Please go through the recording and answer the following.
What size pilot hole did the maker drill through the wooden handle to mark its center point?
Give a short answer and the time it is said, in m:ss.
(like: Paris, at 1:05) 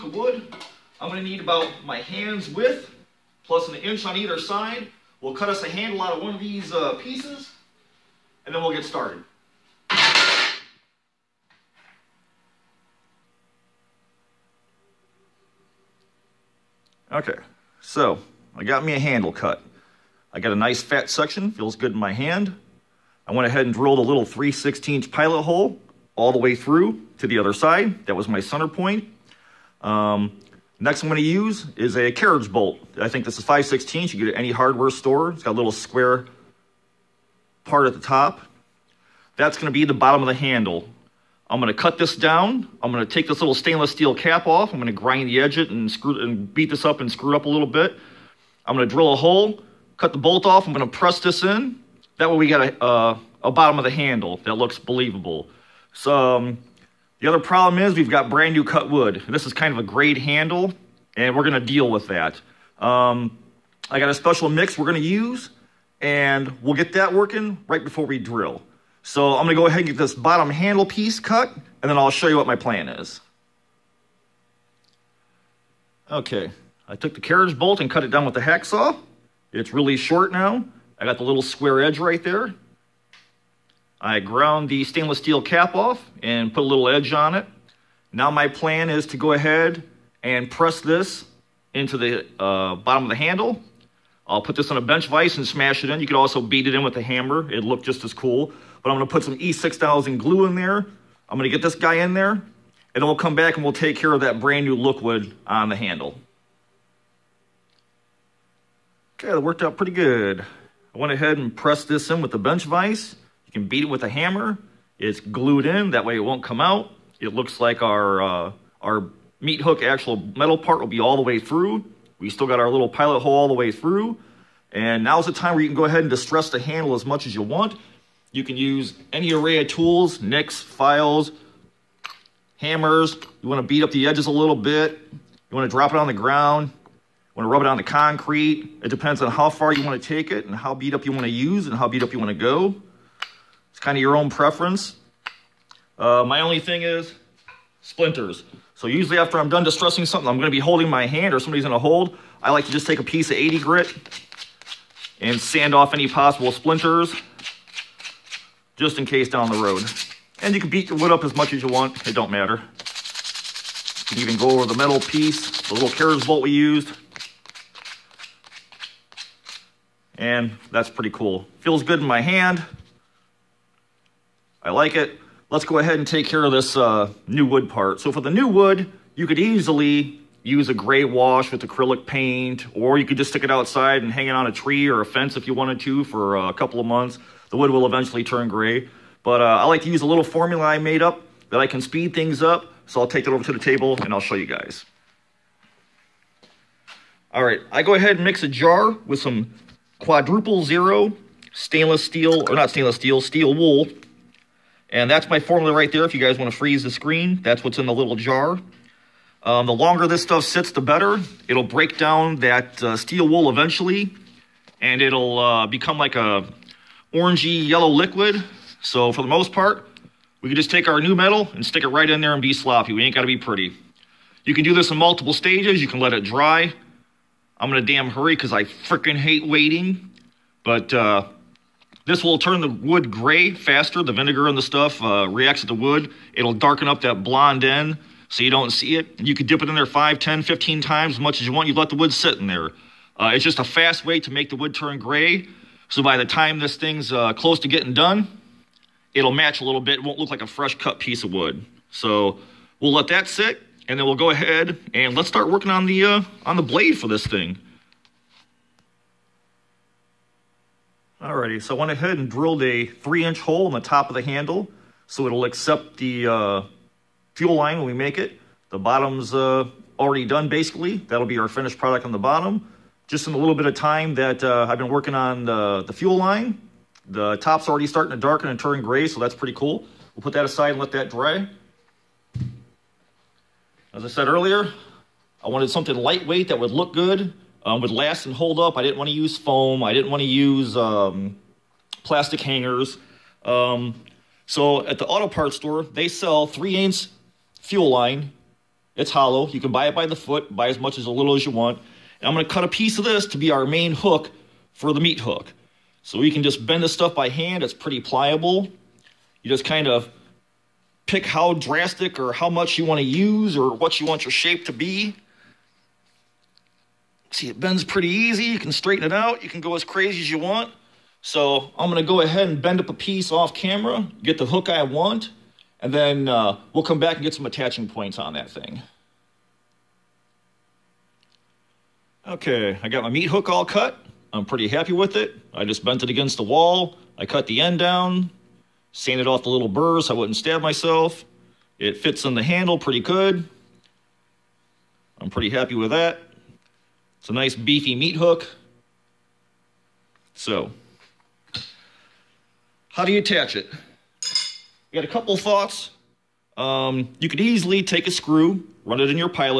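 3/16, at 0:24.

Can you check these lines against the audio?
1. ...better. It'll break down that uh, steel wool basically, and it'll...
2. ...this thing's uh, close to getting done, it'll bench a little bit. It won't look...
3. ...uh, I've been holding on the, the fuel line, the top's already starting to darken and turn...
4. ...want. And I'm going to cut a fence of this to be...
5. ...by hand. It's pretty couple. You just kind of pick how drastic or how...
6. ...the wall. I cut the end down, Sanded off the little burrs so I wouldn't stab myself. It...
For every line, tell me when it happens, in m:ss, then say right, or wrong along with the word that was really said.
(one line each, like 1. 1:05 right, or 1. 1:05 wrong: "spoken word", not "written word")
1. 3:30 wrong: "eventually", not "basically"
2. 4:06 wrong: "match", not "bench"
3. 4:34 wrong: "working", not "holding"
4. 5:01 wrong: "piece", not "fence"
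5. 5:07 wrong: "pliable", not "couple"
6. 5:36 right.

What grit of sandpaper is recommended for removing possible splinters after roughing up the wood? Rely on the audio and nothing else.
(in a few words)
80.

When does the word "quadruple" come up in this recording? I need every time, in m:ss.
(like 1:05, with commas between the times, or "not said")
3:20.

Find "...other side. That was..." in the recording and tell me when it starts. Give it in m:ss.
0:27.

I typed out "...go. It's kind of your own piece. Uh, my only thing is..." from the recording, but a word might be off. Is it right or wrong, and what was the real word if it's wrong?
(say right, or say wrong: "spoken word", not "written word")
wrong: "preference", not "piece".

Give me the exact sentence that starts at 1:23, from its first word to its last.
I ground the stainless steel cap off and put a little edge on it.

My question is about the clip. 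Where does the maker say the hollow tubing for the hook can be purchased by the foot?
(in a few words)
auto parts store.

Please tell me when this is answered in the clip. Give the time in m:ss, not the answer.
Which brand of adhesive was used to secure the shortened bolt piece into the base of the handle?
1:39.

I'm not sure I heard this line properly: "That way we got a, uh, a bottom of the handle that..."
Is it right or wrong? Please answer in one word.
right.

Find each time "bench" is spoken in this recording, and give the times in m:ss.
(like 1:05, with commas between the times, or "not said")
1:34, 1:52.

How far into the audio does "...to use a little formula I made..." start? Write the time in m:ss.
3:09.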